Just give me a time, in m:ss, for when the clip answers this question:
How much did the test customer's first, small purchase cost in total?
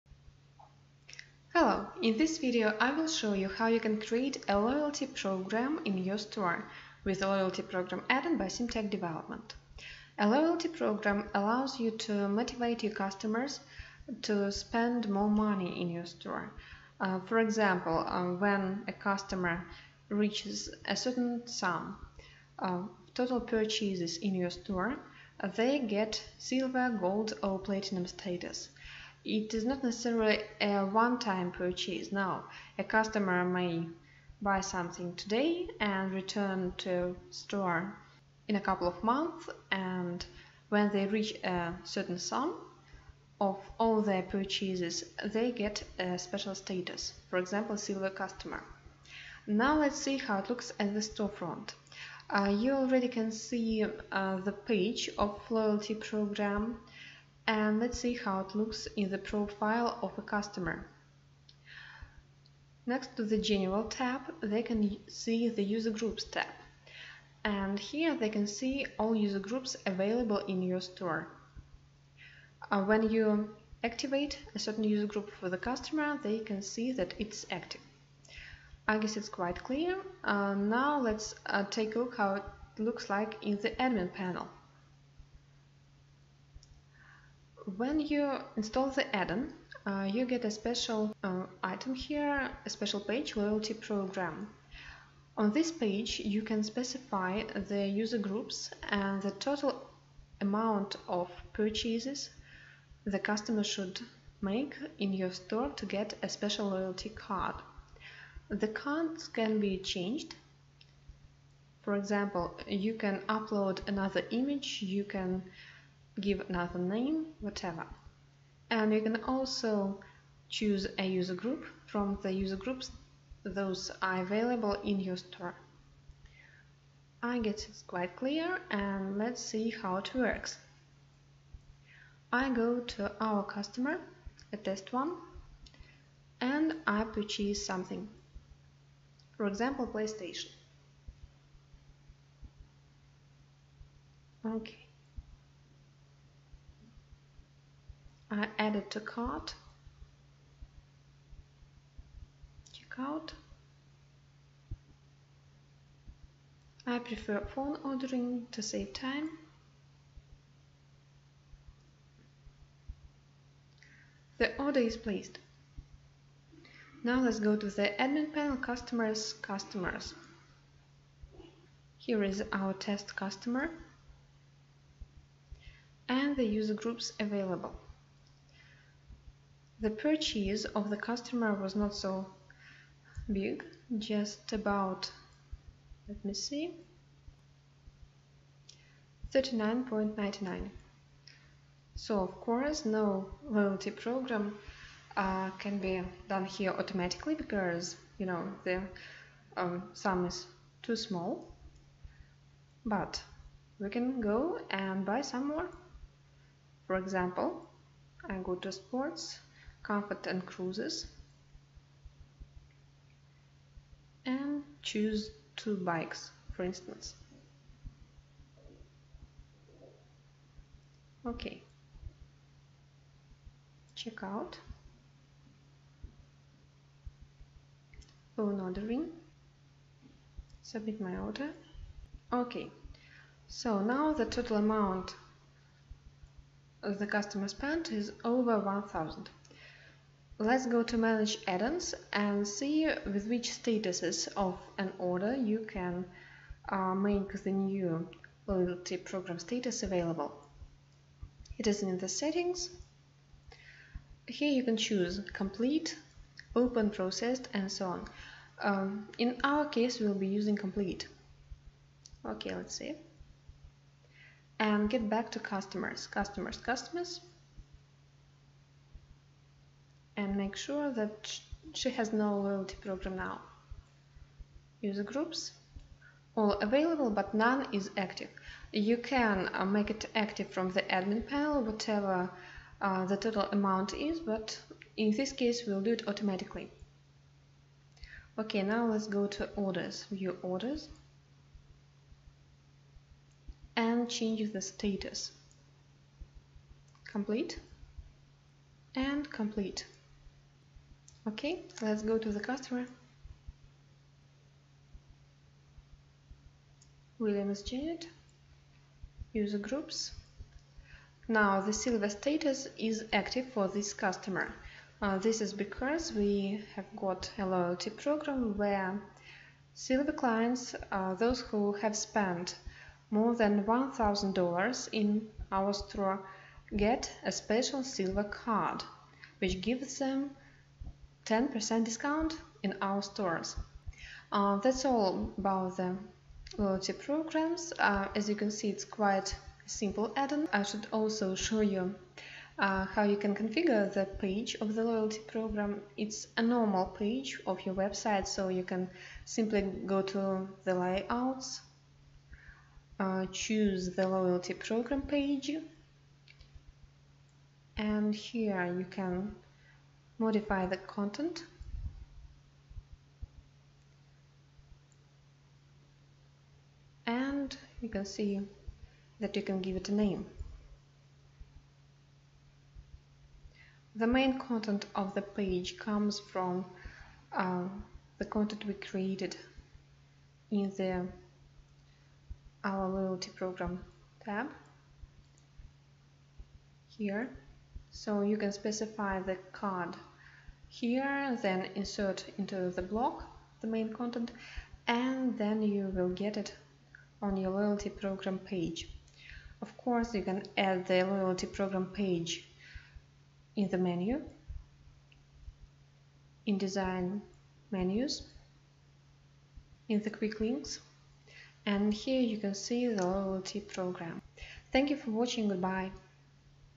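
3:09.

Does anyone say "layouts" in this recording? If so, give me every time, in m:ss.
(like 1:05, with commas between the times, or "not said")
5:50.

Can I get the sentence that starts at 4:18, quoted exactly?
Um, in our case we'll be using complete.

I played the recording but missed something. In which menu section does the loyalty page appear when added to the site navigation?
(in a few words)
quick links.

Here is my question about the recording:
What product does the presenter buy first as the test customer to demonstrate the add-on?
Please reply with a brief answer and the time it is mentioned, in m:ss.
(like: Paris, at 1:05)
PlayStation, at 2:19.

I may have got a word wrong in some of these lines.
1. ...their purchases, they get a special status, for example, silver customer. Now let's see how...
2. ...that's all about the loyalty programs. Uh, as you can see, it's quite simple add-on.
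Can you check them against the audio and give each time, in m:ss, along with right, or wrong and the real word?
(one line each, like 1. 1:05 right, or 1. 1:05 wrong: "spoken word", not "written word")
1. 0:44 right
2. 5:34 right.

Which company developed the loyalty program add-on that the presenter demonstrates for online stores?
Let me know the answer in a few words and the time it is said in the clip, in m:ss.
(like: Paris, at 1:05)
Simtech Development, at 0:08.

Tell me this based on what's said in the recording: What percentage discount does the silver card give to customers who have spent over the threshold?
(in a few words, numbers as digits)
10%.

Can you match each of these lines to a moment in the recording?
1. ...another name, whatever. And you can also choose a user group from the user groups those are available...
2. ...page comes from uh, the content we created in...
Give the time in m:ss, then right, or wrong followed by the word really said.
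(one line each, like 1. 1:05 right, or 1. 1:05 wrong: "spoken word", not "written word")
1. 1:56 right
2. 6:15 right.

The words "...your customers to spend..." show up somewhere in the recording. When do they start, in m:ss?
0:12.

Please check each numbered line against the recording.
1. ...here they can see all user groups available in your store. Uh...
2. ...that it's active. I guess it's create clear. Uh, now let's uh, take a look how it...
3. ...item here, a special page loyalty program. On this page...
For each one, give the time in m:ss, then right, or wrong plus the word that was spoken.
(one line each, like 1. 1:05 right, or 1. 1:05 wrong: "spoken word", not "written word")
1. 1:07 right
2. 1:16 wrong: "quite", not "create"
3. 1:31 right.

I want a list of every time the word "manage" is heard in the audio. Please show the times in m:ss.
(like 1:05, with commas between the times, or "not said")
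4:00.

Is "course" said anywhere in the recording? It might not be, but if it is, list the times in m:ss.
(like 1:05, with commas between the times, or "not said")
3:12, 6:39.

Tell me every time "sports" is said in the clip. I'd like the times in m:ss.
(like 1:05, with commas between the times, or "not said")
3:28.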